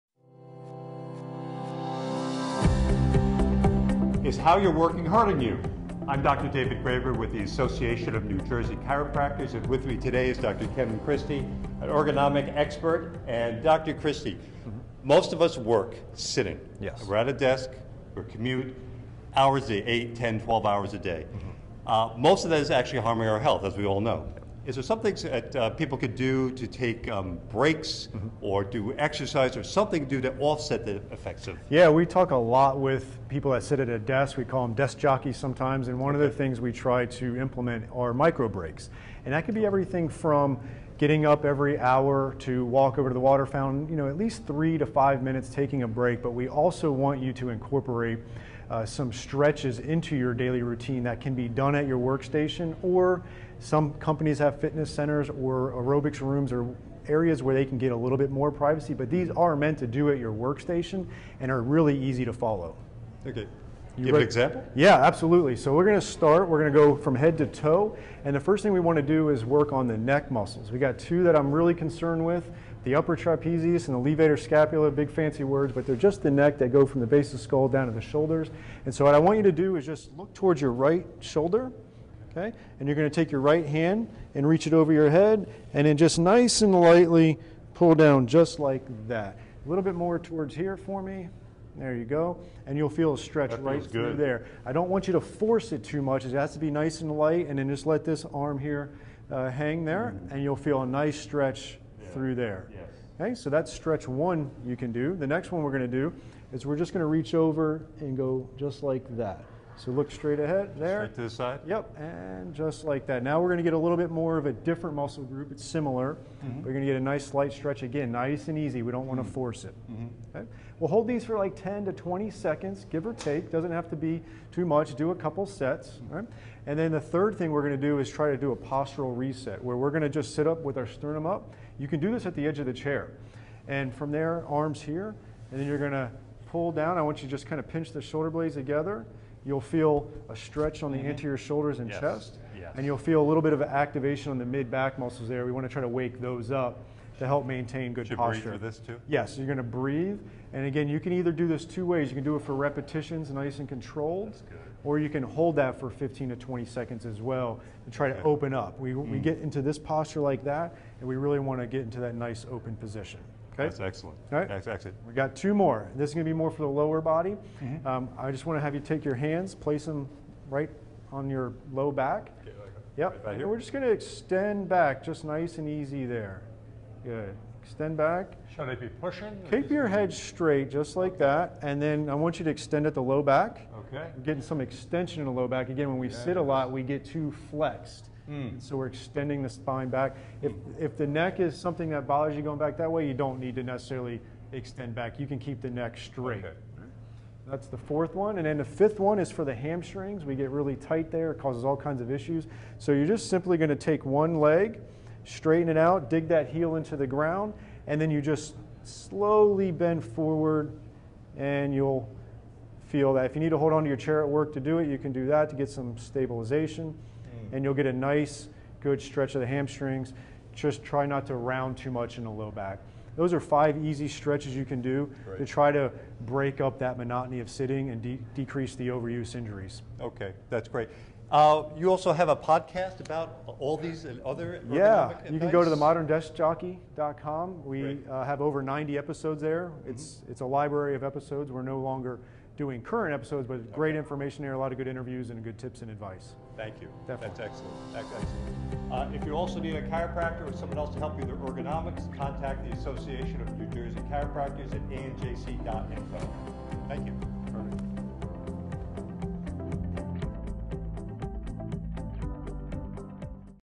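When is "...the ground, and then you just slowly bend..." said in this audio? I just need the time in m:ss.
3:26.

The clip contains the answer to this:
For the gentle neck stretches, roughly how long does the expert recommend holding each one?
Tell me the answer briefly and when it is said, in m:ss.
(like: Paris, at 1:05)
10 to 20 seconds, at 2:01.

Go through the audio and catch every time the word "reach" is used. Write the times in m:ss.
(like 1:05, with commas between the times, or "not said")
1:24, 1:47.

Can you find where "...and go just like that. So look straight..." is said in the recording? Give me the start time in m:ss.
1:47.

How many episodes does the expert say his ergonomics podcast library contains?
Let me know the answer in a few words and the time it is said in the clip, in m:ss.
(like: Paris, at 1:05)
over 90, at 3:58.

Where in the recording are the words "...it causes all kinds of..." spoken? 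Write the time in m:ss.
3:21.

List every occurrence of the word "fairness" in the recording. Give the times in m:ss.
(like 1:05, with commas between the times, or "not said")
not said.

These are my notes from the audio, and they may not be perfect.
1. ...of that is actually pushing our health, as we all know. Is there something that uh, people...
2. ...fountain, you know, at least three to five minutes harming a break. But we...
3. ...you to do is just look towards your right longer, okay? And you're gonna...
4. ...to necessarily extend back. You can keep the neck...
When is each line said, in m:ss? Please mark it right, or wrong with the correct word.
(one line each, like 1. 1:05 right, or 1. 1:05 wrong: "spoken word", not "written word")
1. 0:22 wrong: "harming", not "pushing"
2. 0:43 wrong: "taking", not "harming"
3. 1:19 wrong: "shoulder", not "longer"
4. 3:13 right.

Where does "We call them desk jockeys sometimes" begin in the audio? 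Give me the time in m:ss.
0:34.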